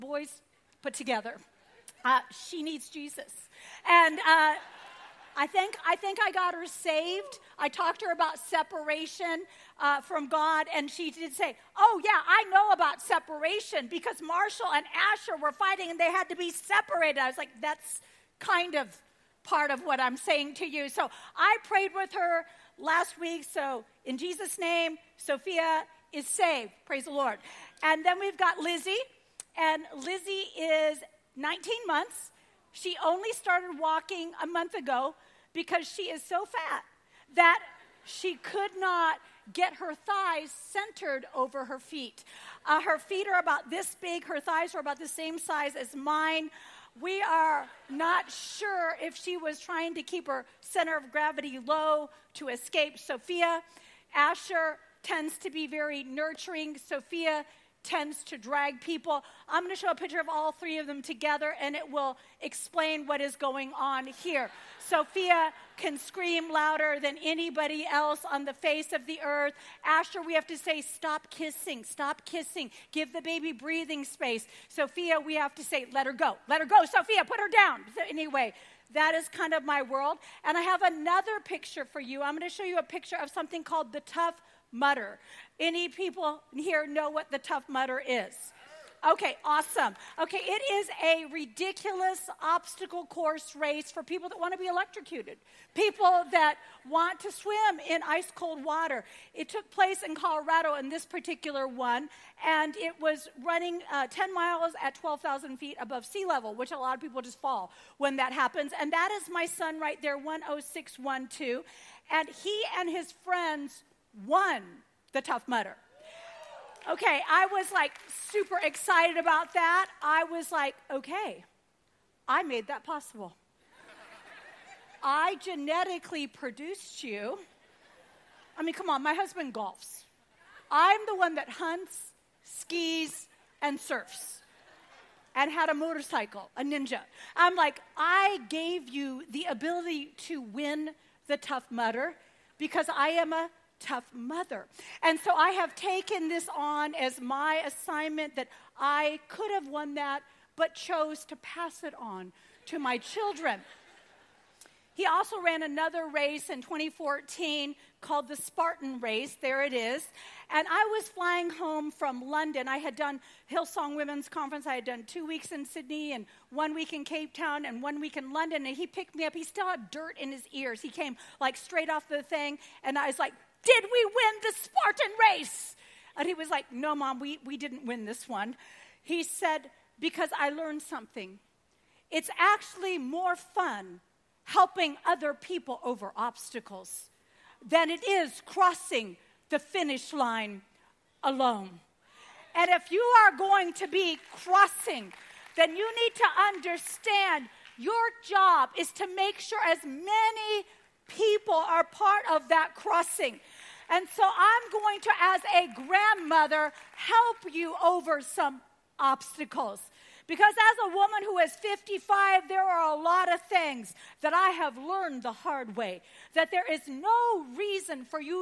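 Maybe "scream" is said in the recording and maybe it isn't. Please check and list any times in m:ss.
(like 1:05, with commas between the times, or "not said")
1:05.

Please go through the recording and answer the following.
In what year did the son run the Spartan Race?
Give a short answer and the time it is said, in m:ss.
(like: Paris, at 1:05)
2014, at 2:36.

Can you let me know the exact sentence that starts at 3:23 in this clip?
And so I'm going to, as a grandmother, help you over some obstacles.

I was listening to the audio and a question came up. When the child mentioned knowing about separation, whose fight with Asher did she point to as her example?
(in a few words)
Marshall.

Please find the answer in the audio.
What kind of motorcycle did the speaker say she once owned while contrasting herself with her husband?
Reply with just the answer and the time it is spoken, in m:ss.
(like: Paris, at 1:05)
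A ninja, at 2:16.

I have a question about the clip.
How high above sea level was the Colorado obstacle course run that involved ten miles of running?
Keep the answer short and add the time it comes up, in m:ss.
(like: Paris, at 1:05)
12,000 feet, at 1:44.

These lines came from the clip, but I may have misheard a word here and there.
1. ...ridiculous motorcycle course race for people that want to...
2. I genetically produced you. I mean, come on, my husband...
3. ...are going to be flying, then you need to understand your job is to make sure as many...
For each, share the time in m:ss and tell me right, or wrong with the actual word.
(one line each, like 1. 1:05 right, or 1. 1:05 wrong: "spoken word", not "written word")
1. 1:31 wrong: "obstacle", not "motorcycle"
2. 2:05 right
3. 3:13 wrong: "crossing", not "flying".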